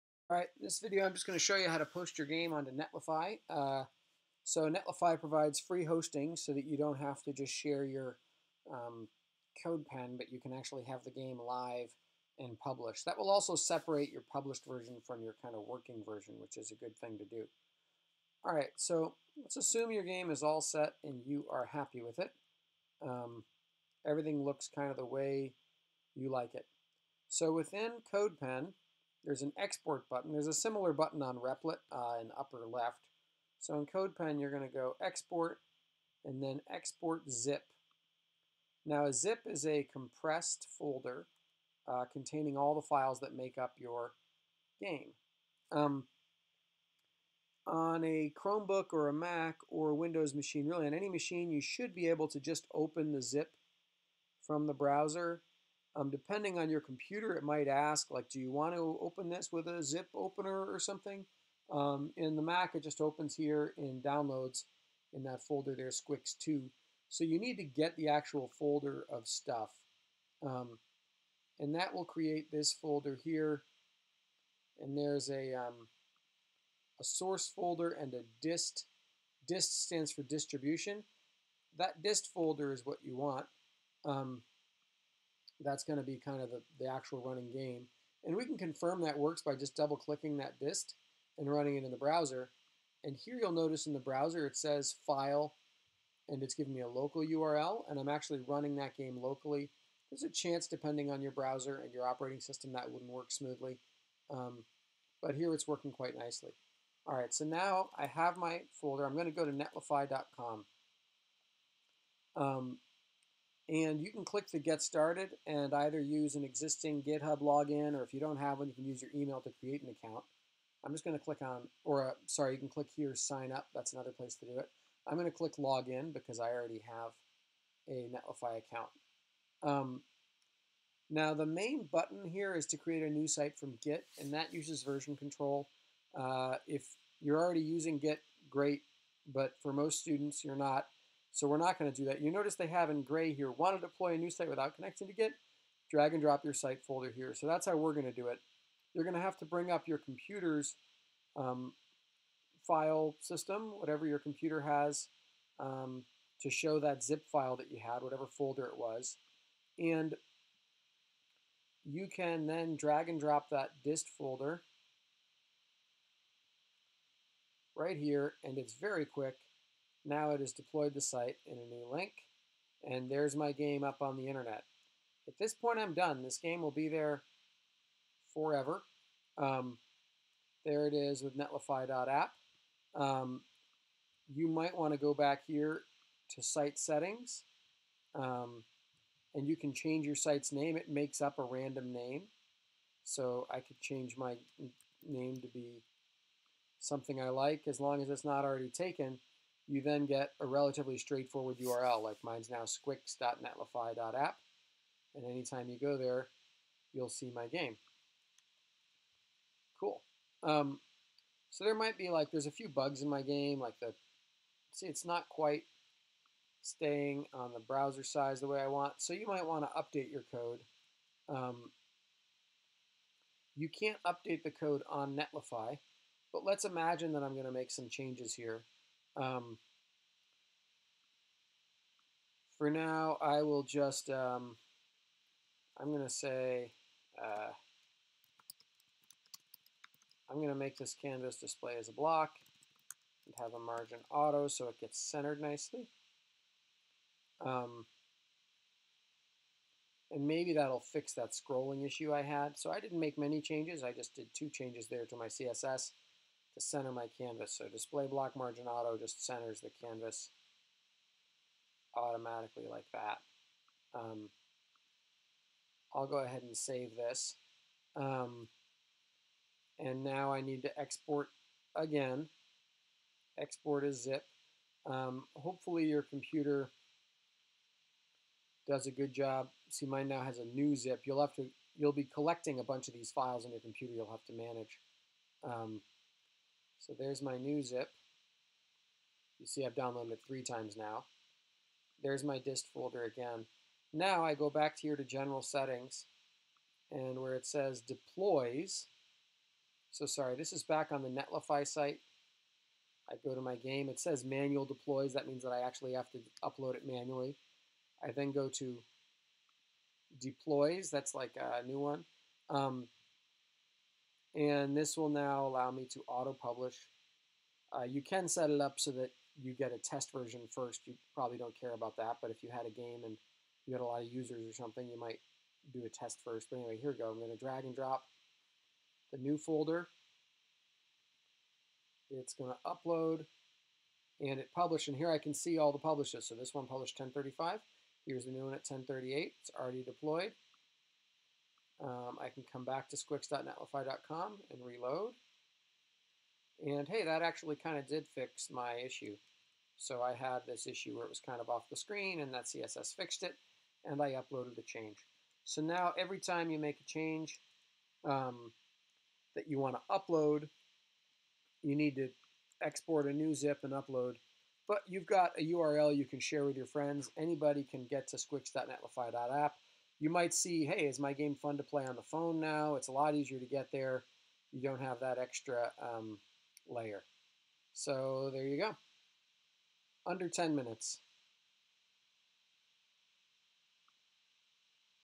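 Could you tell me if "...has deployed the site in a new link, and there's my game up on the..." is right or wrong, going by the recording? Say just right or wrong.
right.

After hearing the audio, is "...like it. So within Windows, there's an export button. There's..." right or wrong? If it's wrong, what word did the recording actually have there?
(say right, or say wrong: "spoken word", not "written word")
wrong: "CodePen", not "Windows".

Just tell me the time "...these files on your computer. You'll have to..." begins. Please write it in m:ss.
4:42.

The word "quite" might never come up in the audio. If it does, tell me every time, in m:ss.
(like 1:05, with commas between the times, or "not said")
1:45, 3:35.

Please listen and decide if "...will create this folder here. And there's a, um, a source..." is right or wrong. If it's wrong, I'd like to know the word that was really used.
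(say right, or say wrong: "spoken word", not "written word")
right.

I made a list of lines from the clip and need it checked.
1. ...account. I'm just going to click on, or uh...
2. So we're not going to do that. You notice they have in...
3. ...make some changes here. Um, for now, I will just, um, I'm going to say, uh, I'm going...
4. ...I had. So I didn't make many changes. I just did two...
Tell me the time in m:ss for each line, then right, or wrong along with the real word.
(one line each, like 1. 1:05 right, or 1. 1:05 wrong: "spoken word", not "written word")
1. 2:00 right
2. 2:21 right
3. 3:47 right
4. 4:12 right.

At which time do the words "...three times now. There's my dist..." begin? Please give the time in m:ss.
4:50.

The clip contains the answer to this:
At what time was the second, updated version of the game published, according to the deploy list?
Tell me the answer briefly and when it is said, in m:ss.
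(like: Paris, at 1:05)
10:38, at 5:38.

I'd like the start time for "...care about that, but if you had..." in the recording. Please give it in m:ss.
5:21.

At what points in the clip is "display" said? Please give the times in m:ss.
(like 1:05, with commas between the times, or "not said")
4:01, 4:17.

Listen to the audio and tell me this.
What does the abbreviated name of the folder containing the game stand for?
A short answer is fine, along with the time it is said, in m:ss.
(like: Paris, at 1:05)
distribution, at 1:20.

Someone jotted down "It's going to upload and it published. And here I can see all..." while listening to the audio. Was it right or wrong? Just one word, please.
right.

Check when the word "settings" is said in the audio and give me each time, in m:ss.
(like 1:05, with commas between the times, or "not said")
3:06, 4:55.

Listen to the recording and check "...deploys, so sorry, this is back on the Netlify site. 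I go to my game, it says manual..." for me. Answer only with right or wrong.
right.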